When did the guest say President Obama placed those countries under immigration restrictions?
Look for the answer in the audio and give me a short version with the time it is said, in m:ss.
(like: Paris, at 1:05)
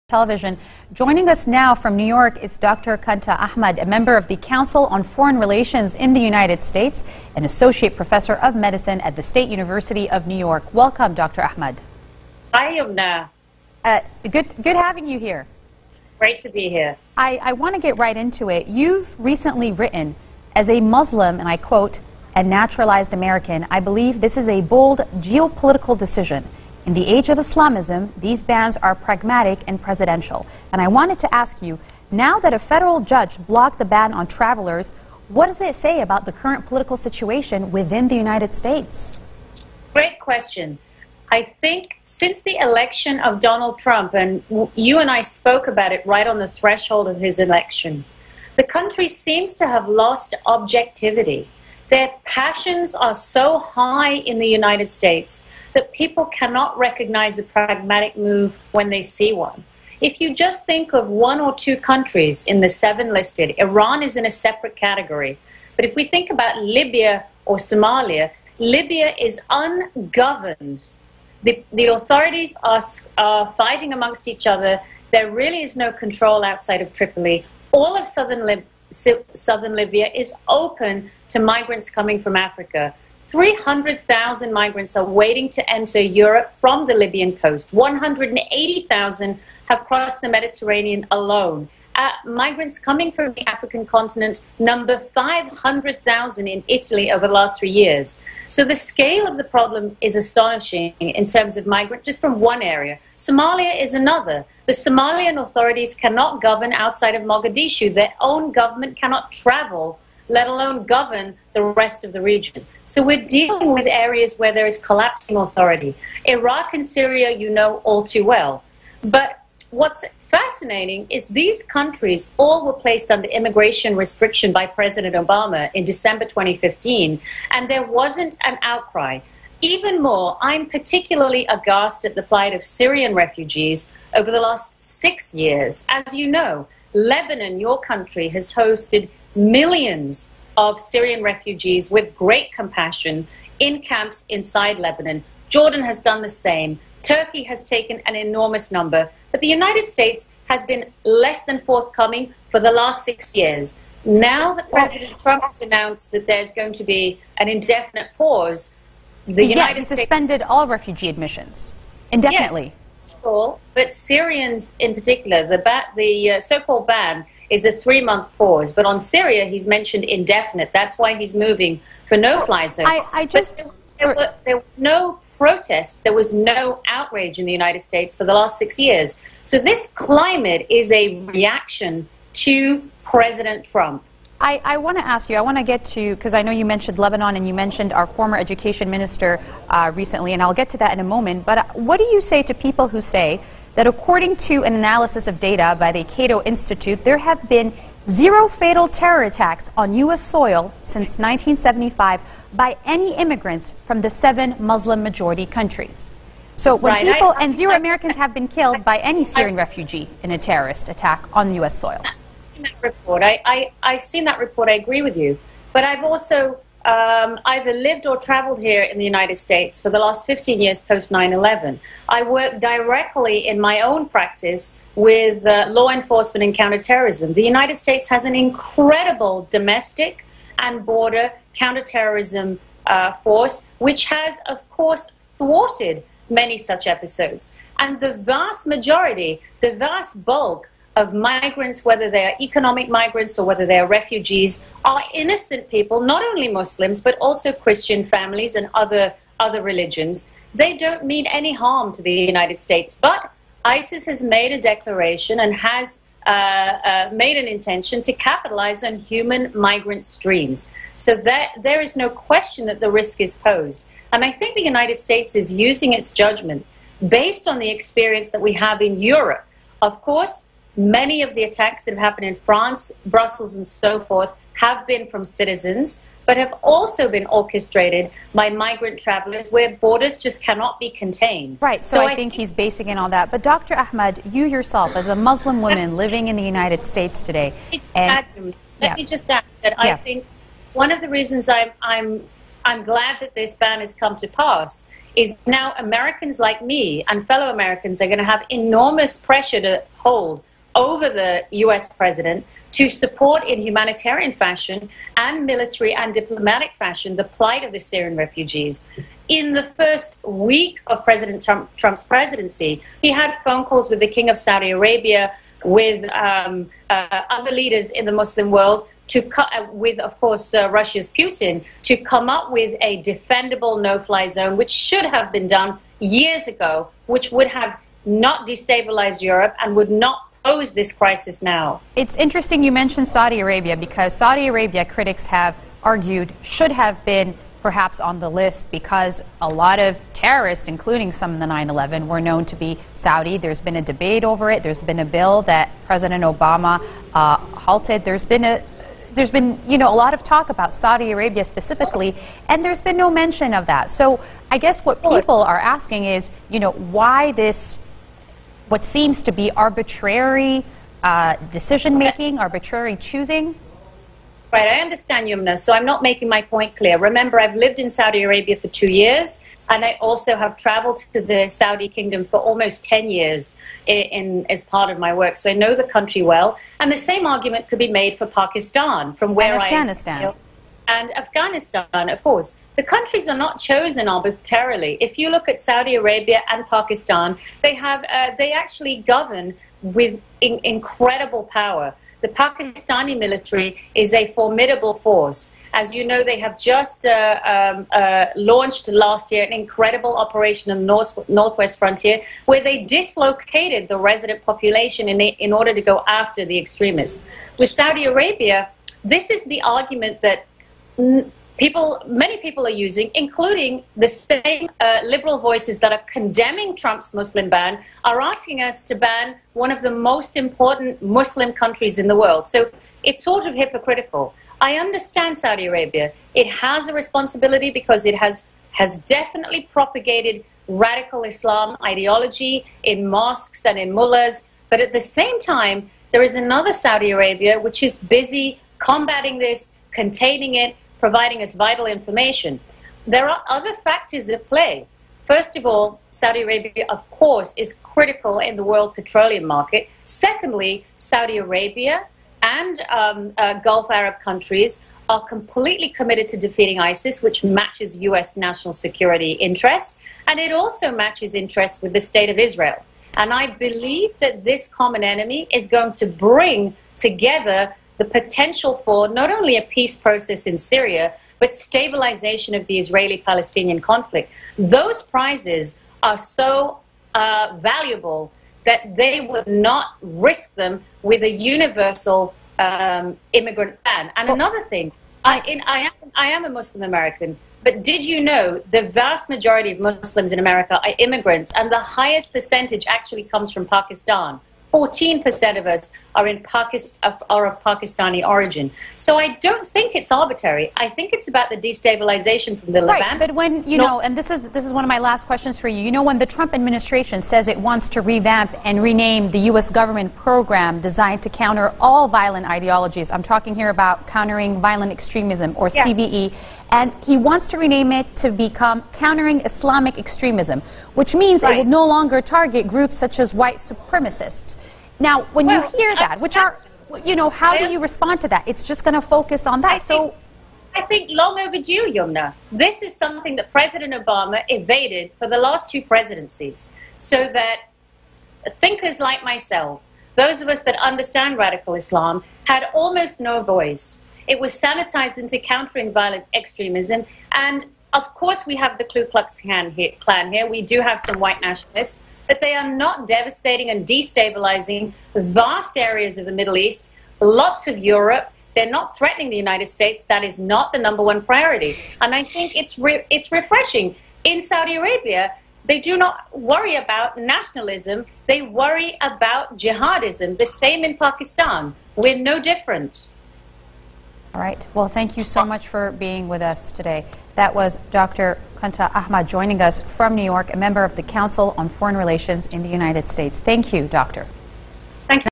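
December 2015, at 2:05.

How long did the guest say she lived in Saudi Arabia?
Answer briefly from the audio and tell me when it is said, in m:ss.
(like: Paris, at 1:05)
two years, at 6:08.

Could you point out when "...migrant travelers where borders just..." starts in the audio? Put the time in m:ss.
4:38.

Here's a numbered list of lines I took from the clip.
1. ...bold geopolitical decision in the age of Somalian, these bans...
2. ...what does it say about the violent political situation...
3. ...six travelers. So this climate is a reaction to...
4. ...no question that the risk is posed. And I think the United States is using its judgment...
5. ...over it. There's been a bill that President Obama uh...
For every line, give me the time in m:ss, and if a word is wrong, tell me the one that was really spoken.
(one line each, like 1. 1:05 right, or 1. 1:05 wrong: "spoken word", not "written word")
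1. 0:24 wrong: "Islamism", not "Somalian"
2. 0:35 wrong: "current", not "violent"
3. 2:58 wrong: "years", not "travelers"
4. 4:21 right
5. 5:44 right.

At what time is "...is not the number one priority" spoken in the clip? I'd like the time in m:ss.
9:20.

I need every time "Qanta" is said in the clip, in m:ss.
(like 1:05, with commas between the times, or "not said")
0:02, 9:38.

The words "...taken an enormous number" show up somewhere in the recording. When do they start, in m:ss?
2:27.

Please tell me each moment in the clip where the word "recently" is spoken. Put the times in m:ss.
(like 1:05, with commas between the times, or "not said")
0:19, 3:09.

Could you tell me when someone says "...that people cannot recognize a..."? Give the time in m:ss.
0:55.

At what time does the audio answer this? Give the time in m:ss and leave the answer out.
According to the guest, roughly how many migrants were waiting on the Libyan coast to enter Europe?
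1:23.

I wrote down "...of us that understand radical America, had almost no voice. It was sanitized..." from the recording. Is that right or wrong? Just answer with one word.
wrong.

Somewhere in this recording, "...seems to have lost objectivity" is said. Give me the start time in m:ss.
0:49.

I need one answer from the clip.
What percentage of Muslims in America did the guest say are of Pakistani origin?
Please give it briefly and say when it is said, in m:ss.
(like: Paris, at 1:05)
14%, at 8:14.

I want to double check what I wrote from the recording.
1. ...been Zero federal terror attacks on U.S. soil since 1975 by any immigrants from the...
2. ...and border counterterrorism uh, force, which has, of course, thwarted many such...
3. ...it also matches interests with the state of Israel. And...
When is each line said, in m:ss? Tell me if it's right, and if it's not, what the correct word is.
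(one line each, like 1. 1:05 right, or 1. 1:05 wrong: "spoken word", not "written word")
1. 3:17 wrong: "fatal", not "federal"
2. 3:50 right
3. 7:40 right.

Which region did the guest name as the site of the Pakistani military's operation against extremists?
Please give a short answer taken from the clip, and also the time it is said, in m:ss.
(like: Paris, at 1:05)
Northwest Frontier, at 6:41.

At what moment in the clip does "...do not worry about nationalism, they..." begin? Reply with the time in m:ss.
9:25.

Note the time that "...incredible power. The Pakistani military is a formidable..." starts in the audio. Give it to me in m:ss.
6:30.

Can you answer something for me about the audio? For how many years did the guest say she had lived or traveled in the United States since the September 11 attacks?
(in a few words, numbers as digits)
15 years.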